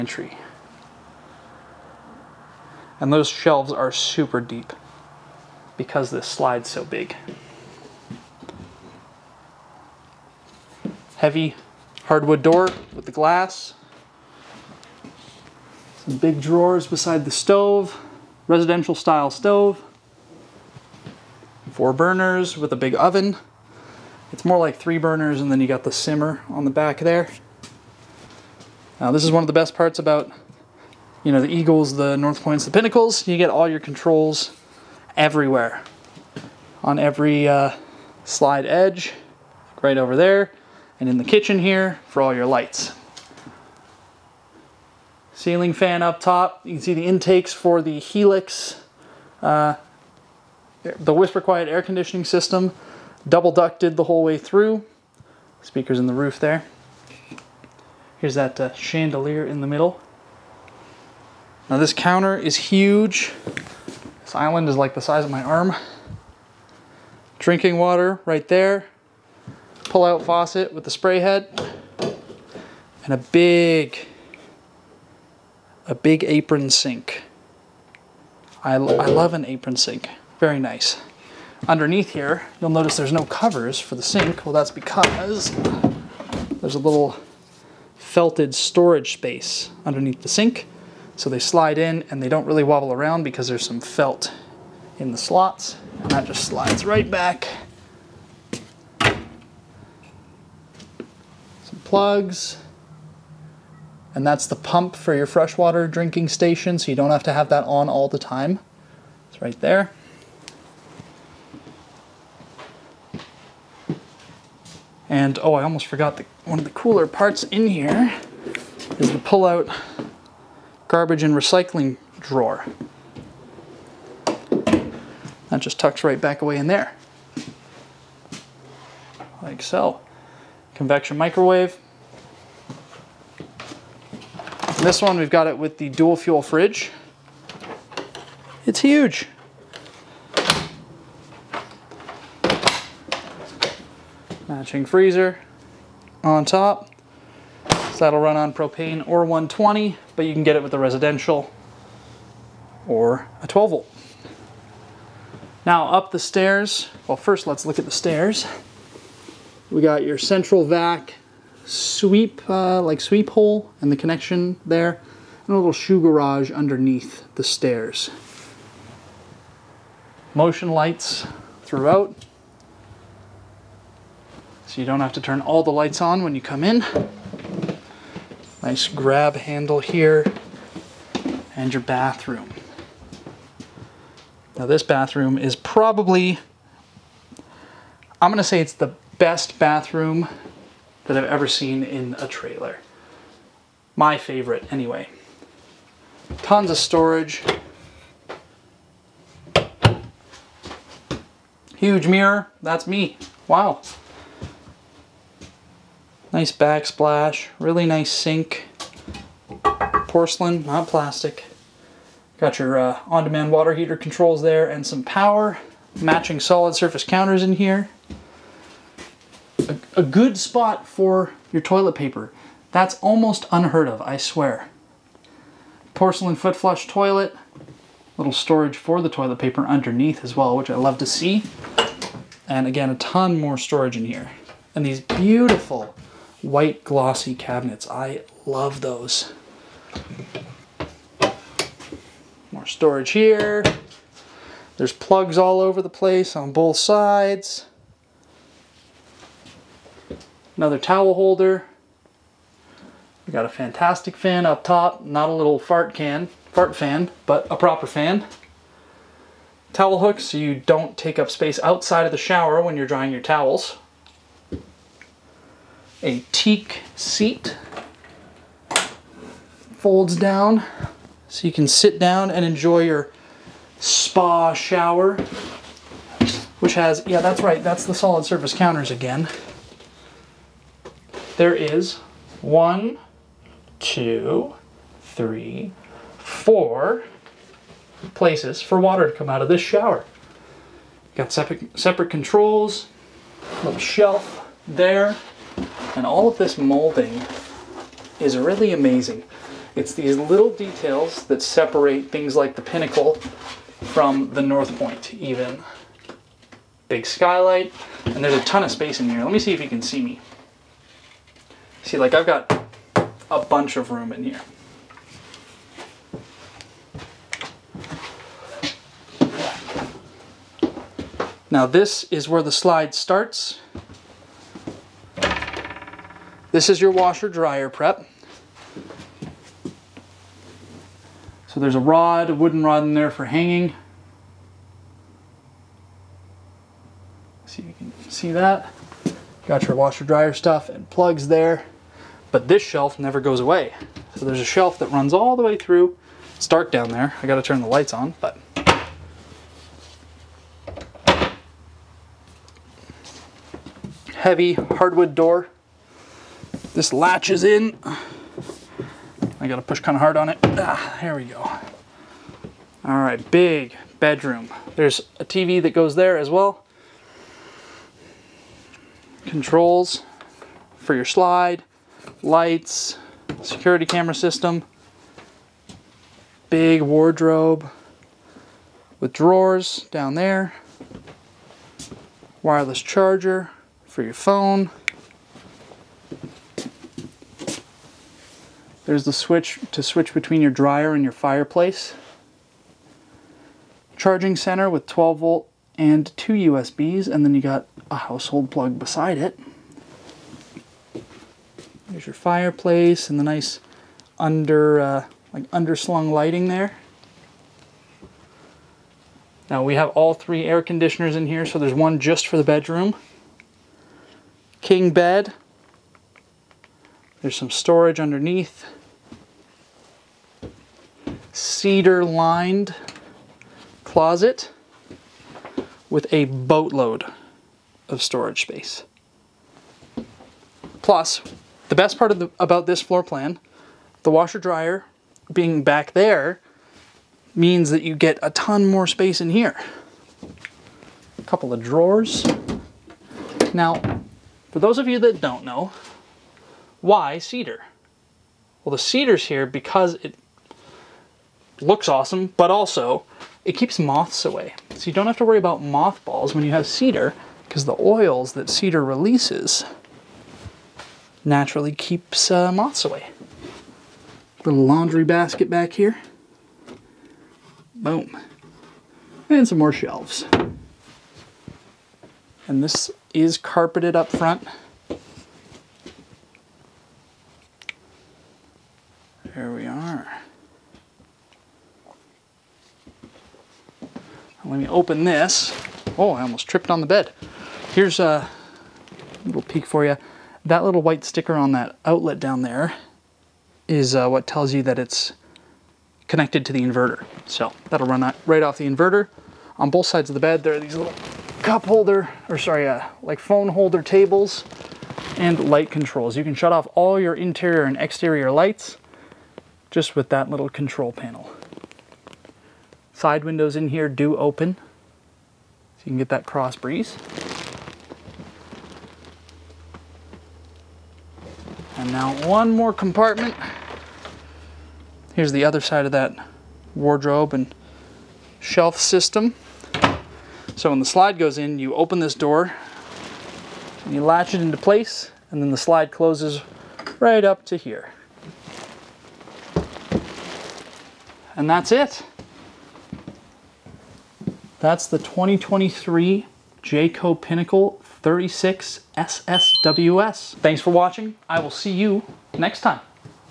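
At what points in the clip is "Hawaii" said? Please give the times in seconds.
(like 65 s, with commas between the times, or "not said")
not said.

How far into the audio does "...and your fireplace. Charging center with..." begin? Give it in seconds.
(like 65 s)
390 s.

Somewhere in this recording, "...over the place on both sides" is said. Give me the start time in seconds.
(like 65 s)
245 s.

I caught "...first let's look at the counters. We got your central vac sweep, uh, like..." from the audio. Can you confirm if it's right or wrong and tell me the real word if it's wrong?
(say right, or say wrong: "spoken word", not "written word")
wrong: "stairs", not "counters".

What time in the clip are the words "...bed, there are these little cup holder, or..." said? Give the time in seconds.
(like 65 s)
500 s.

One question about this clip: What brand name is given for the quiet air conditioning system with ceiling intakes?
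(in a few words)
Helix.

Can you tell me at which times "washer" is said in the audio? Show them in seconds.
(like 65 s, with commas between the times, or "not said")
326 s, 339 s, 434 s.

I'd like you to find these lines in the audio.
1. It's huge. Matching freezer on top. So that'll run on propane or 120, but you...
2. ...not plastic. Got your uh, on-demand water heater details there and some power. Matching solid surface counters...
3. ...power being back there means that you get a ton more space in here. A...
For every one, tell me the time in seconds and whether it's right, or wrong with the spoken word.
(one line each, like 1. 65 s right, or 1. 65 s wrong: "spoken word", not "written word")
1. 138 s right
2. 210 s wrong: "controls", not "details"
3. 434 s wrong: "dryer", not "power".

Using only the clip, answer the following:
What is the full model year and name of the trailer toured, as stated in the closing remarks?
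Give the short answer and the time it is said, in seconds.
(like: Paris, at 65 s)
2023 Jayco Pinnacle 36 SSWS, at 544 s.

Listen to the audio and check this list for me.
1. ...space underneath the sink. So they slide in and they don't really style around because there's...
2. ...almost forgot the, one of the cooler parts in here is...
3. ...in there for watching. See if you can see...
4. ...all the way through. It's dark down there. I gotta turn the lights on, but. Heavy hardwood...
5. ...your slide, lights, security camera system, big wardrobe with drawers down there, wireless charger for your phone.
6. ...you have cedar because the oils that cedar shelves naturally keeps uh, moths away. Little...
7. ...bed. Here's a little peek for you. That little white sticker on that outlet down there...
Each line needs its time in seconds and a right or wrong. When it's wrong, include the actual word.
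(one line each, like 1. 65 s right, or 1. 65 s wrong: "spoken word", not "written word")
1. 89 s wrong: "wobble", not "style"
2. 115 s right
3. 332 s wrong: "hanging", not "watching"
4. 345 s right
5. 370 s right
6. 456 s wrong: "releases", not "shelves"
7. 486 s right.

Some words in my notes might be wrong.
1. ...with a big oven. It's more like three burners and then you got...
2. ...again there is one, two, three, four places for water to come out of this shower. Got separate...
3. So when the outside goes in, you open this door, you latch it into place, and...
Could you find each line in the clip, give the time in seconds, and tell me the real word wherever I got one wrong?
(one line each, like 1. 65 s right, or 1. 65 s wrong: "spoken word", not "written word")
1. 22 s right
2. 278 s right
3. 530 s wrong: "slide", not "outside".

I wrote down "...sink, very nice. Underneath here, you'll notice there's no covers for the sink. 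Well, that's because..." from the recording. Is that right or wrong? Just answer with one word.
right.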